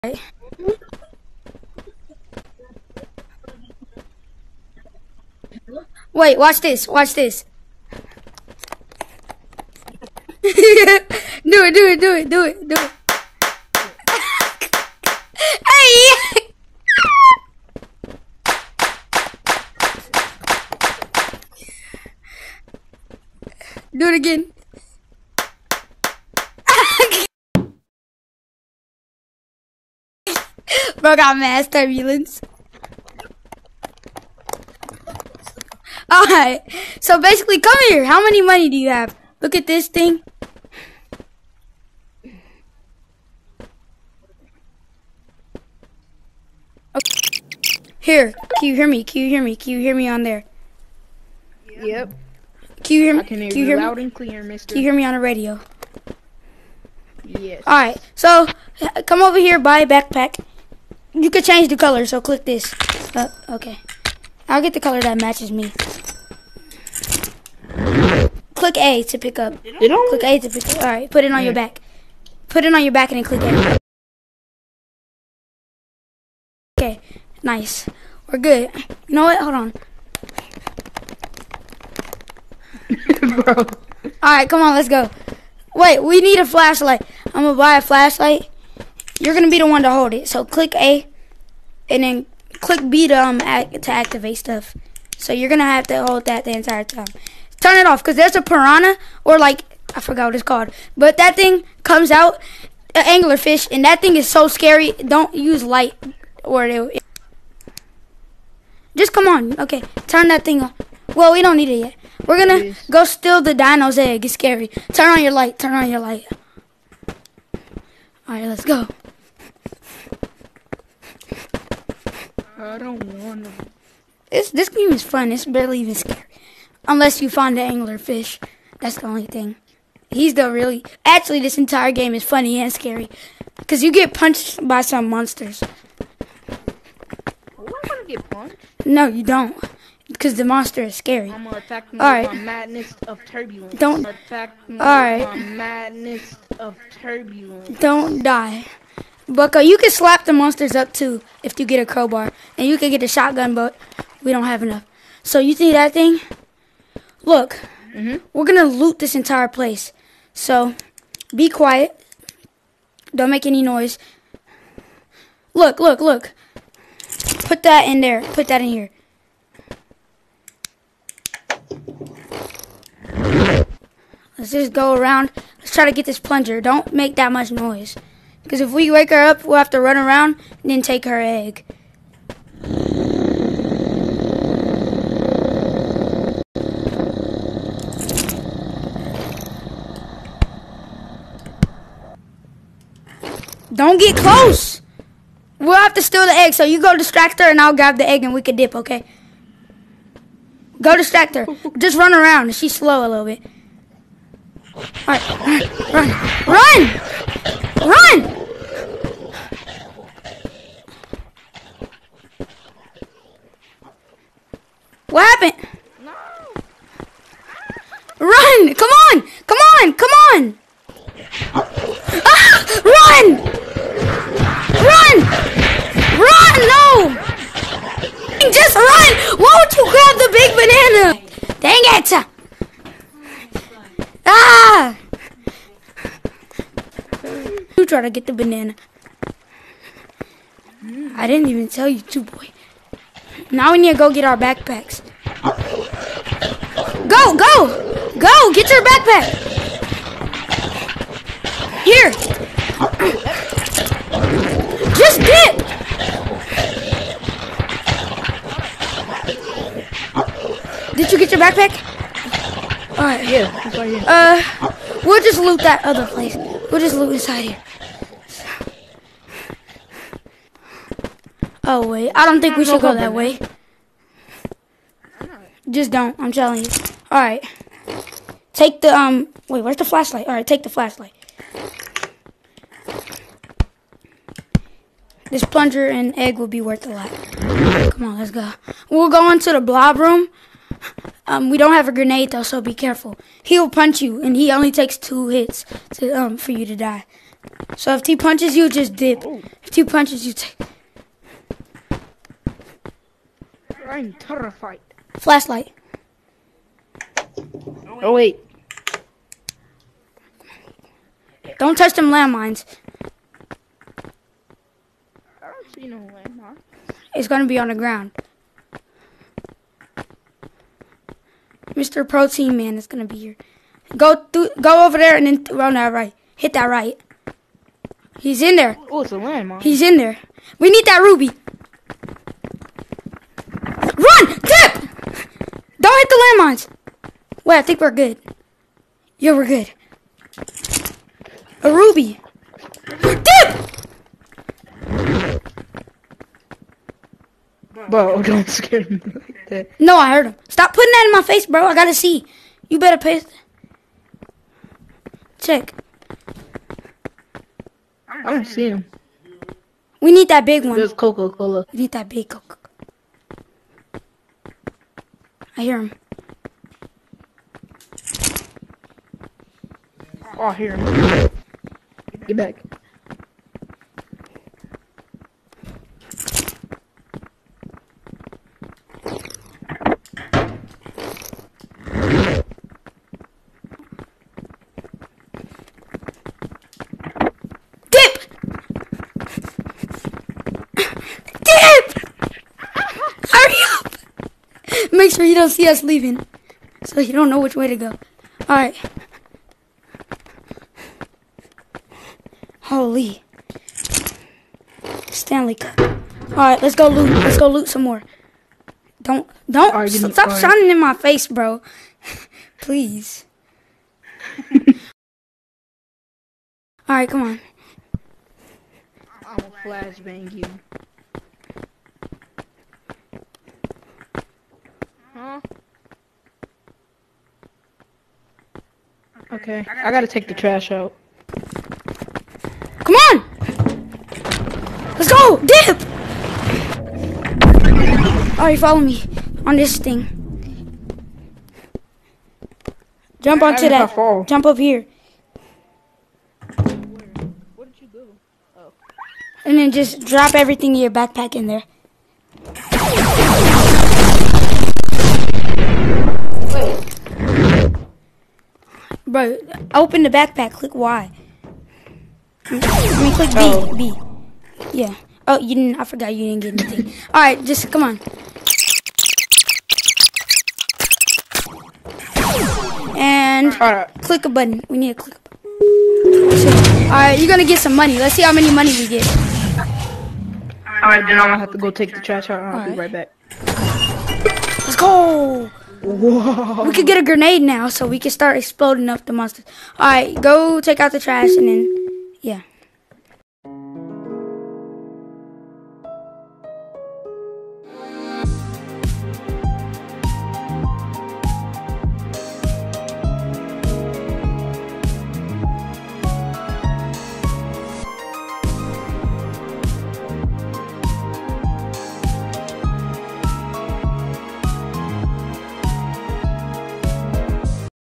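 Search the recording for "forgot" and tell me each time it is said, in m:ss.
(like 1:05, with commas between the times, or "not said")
1:40, 7:45.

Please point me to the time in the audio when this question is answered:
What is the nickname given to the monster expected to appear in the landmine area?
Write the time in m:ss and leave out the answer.
5:21.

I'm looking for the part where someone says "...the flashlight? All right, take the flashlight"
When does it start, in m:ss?
4:39.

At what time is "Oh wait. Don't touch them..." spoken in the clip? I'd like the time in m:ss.
5:08.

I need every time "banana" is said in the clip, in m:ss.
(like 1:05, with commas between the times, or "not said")
3:50, 3:58.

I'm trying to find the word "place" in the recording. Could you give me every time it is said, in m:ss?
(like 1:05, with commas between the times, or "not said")
2:39, 4:26.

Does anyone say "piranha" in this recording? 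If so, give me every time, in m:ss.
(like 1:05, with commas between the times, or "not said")
1:38.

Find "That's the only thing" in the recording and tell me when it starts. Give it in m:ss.
2:08.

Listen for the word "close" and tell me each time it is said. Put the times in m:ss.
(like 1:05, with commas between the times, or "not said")
3:14.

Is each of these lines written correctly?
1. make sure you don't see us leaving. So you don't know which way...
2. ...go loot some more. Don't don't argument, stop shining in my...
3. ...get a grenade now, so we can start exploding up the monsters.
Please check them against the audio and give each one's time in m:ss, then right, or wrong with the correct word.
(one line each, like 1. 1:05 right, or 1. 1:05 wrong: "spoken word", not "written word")
1. 6:34 right
2. 6:47 right
3. 8:06 right.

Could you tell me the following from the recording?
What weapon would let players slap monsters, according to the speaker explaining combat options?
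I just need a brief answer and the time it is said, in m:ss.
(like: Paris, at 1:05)
crowbar, at 2:31.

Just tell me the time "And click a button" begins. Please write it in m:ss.
7:52.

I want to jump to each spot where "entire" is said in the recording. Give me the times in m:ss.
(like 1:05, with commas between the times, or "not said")
1:36, 2:11, 2:39.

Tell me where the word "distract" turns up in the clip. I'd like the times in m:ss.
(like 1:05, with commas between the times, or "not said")
3:16, 3:20.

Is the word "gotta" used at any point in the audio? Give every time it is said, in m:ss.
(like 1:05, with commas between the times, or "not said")
5:51, 7:09.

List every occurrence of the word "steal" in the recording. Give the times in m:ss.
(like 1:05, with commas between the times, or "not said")
1:53, 3:16.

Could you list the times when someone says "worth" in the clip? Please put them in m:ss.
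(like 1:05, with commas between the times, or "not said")
4:46.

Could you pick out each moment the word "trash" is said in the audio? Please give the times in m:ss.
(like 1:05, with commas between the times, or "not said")
7:10, 8:02, 8:10.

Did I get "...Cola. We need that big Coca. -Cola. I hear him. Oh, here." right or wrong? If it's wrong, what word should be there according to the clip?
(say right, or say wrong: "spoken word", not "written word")
right.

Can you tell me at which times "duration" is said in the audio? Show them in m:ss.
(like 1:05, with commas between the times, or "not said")
not said.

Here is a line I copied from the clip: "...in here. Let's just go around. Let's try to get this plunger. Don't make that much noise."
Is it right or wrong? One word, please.
right.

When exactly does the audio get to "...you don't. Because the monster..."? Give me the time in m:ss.
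2:19.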